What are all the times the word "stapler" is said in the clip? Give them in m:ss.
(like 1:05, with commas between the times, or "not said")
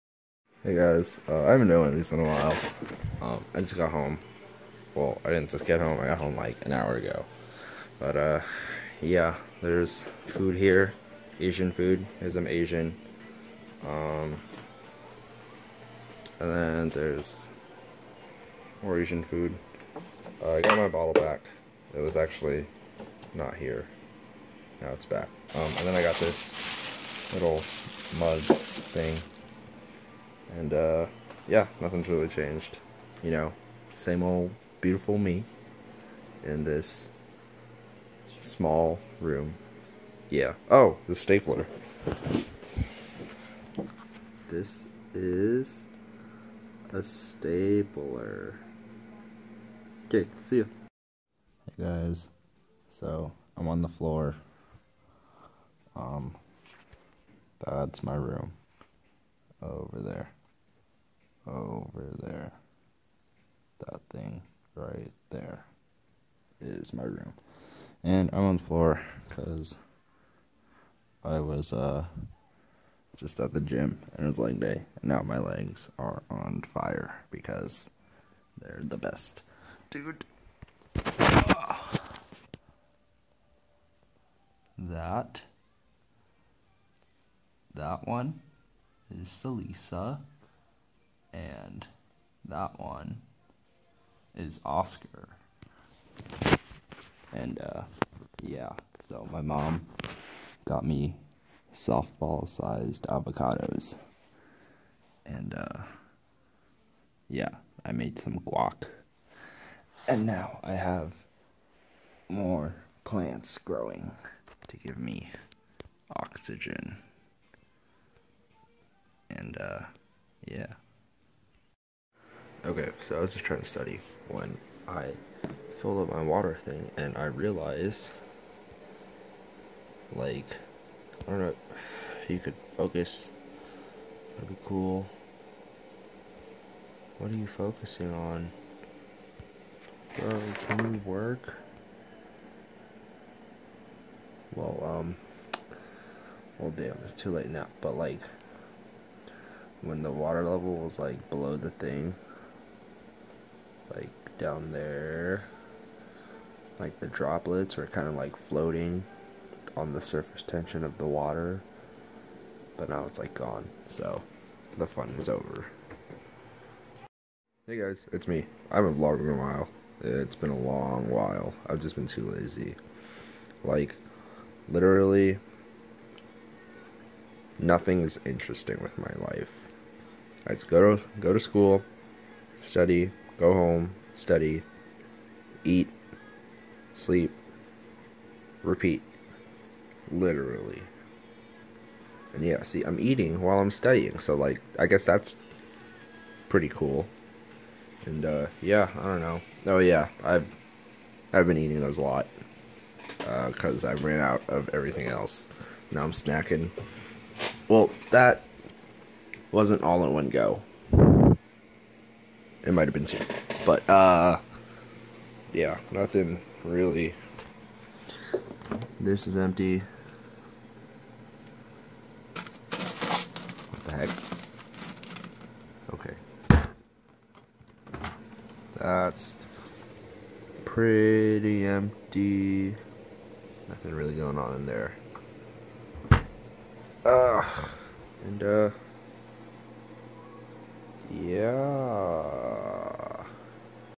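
0:41, 0:47.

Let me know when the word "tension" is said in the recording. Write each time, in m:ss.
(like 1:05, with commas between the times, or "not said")
2:40.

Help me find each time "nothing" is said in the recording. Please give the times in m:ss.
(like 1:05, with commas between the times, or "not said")
0:31, 2:57, 3:35, 3:53.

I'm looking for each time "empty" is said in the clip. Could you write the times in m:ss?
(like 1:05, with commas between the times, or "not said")
3:39, 3:51.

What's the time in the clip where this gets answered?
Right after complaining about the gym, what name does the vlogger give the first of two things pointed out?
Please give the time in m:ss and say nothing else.
1:29.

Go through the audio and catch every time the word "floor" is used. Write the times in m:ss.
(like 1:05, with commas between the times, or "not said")
0:53, 1:08.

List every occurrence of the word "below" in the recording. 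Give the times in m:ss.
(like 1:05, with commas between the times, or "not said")
2:31.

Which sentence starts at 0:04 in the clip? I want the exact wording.
Well, I didn't just get home.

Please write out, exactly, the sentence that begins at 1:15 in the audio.
And now my legs are on fire because they're the best.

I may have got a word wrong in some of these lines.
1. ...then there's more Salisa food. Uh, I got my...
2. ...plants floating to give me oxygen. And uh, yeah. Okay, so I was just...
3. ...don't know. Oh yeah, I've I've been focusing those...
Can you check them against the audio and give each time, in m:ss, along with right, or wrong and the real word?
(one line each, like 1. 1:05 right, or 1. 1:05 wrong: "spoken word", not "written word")
1. 0:16 wrong: "Asian", not "Salisa"
2. 1:53 wrong: "growing", not "floating"
3. 3:19 wrong: "eating", not "focusing".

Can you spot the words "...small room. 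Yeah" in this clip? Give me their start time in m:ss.
0:38.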